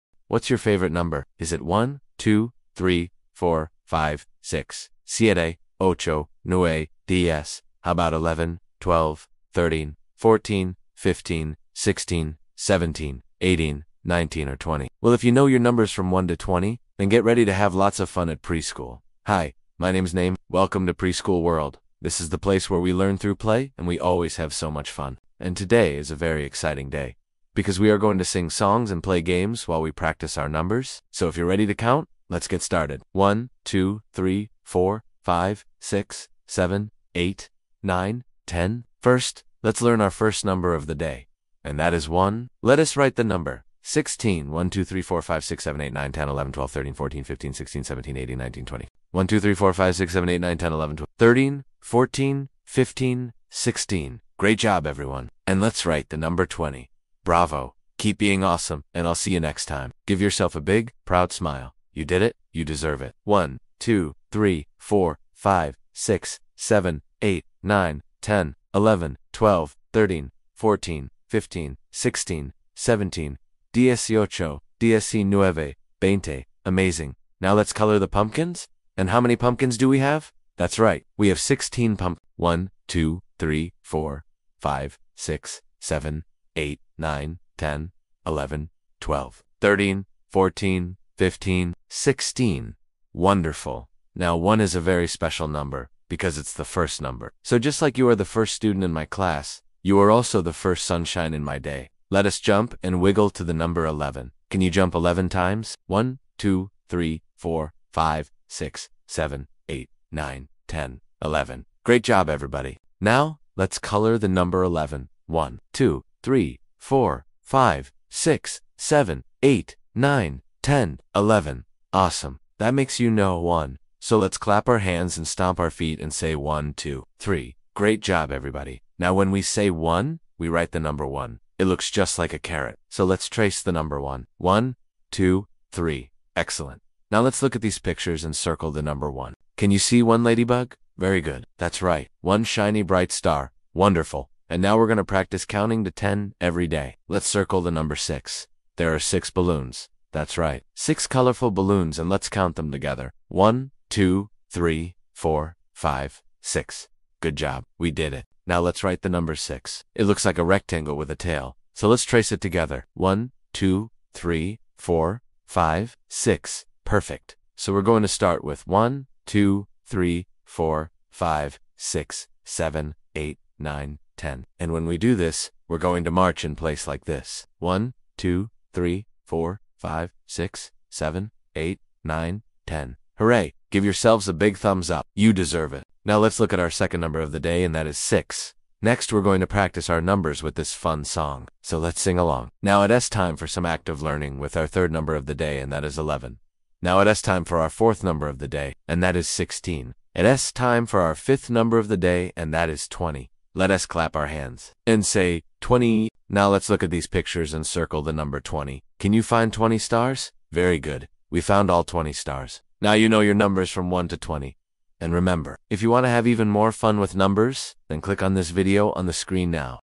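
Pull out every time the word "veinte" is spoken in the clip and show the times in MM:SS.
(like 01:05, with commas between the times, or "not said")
01:16.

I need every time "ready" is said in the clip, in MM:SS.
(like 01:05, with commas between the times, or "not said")
00:17, 00:31.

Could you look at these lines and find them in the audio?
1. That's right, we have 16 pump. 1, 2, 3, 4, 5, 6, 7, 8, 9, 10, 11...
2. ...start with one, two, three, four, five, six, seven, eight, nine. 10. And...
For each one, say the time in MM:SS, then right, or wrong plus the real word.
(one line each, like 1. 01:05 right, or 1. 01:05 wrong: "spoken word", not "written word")
1. 01:20 right
2. 02:48 right.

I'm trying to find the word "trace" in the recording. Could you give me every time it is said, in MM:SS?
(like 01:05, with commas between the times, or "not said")
02:13, 02:42.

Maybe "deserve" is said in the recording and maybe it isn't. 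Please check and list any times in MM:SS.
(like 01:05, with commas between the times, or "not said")
01:02, 03:05.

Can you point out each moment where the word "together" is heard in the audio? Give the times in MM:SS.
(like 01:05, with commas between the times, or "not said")
02:32, 02:42.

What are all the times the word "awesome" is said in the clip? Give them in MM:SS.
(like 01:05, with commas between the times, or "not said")
00:58, 02:01.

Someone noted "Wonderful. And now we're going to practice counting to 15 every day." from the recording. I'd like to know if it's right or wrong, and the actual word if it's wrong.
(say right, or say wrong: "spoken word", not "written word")
wrong: "10", not "15".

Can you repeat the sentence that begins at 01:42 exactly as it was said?
Let us jump and wiggle to the number 11.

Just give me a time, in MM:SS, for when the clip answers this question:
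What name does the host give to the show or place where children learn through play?
00:20.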